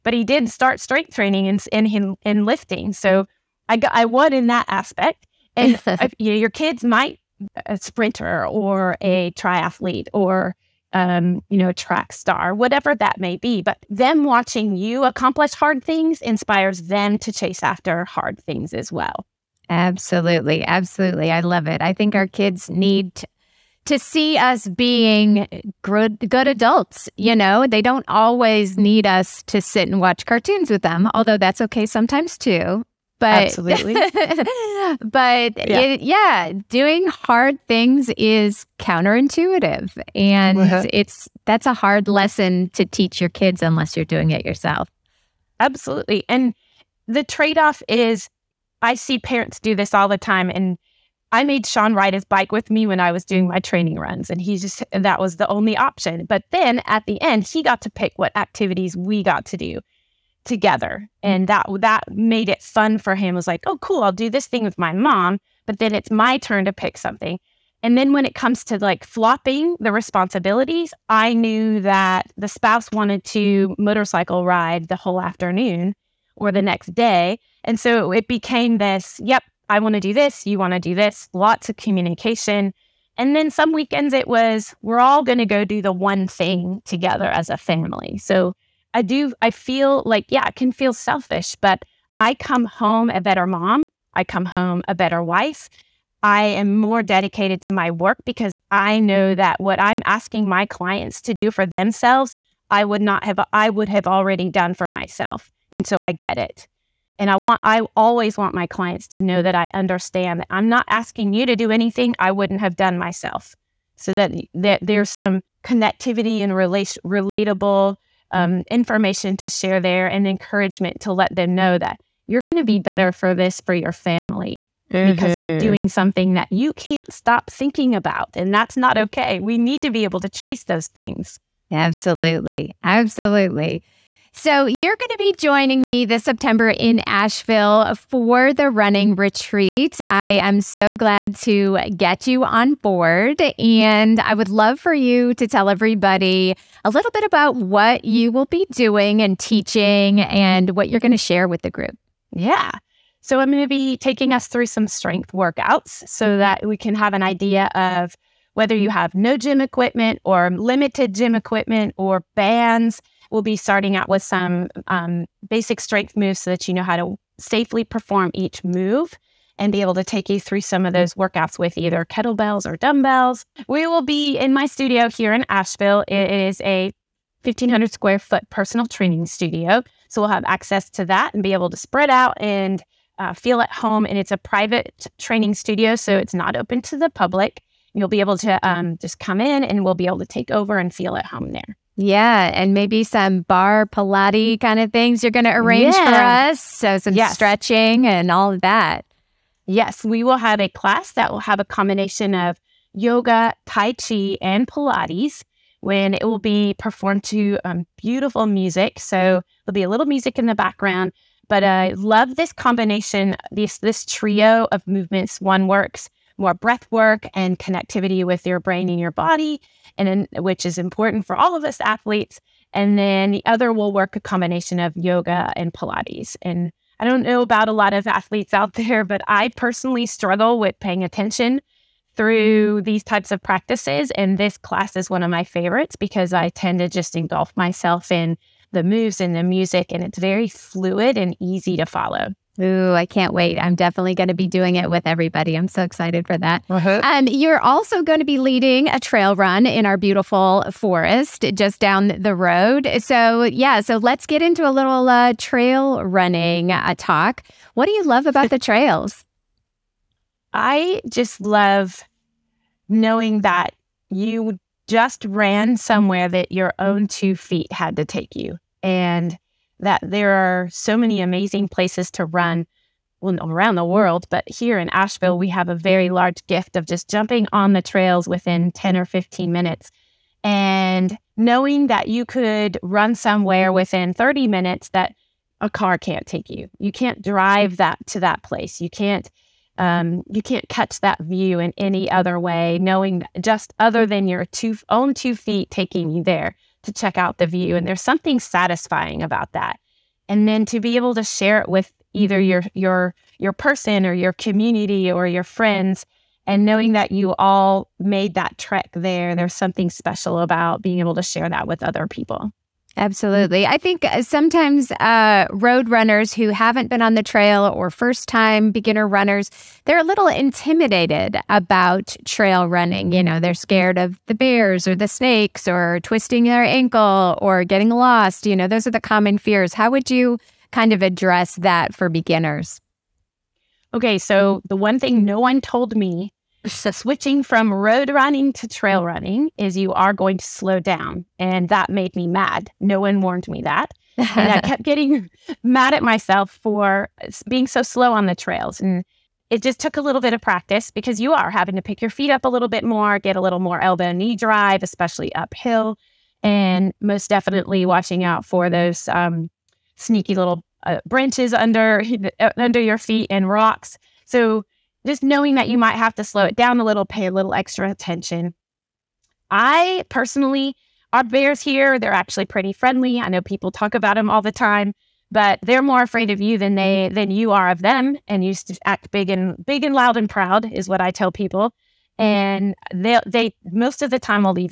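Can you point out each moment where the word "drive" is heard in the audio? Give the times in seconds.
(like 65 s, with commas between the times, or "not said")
287 s, 354 s.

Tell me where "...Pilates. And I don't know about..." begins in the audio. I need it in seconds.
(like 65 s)
225 s.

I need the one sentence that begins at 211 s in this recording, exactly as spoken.
But I love this combination, this this trio of movements.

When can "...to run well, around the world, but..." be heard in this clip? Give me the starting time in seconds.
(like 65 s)
272 s.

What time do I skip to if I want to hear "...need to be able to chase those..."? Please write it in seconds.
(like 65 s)
129 s.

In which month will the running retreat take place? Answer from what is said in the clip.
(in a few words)
September.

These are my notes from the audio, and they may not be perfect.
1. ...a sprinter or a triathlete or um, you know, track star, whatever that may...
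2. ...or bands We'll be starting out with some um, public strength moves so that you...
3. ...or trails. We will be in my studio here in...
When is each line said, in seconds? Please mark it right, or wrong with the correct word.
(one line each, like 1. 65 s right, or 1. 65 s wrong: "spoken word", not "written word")
1. 7 s right
2. 161 s wrong: "basic", not "public"
3. 172 s wrong: "dumbbells", not "trails".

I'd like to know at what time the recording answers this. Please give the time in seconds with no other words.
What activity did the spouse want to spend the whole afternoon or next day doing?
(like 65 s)
73 s.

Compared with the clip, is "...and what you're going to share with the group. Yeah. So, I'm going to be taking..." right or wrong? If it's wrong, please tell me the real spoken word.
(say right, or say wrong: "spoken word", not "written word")
right.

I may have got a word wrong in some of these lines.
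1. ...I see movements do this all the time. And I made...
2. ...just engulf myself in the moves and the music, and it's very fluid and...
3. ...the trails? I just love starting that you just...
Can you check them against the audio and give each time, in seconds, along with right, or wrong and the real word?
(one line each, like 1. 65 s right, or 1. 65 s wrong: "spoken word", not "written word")
1. 48 s wrong: "parents", not "movements"
2. 236 s right
3. 258 s wrong: "knowing", not "starting".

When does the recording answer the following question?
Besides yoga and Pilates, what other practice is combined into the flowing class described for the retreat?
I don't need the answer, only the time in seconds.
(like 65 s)
203 s.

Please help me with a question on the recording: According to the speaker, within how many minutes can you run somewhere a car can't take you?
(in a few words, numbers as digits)
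30.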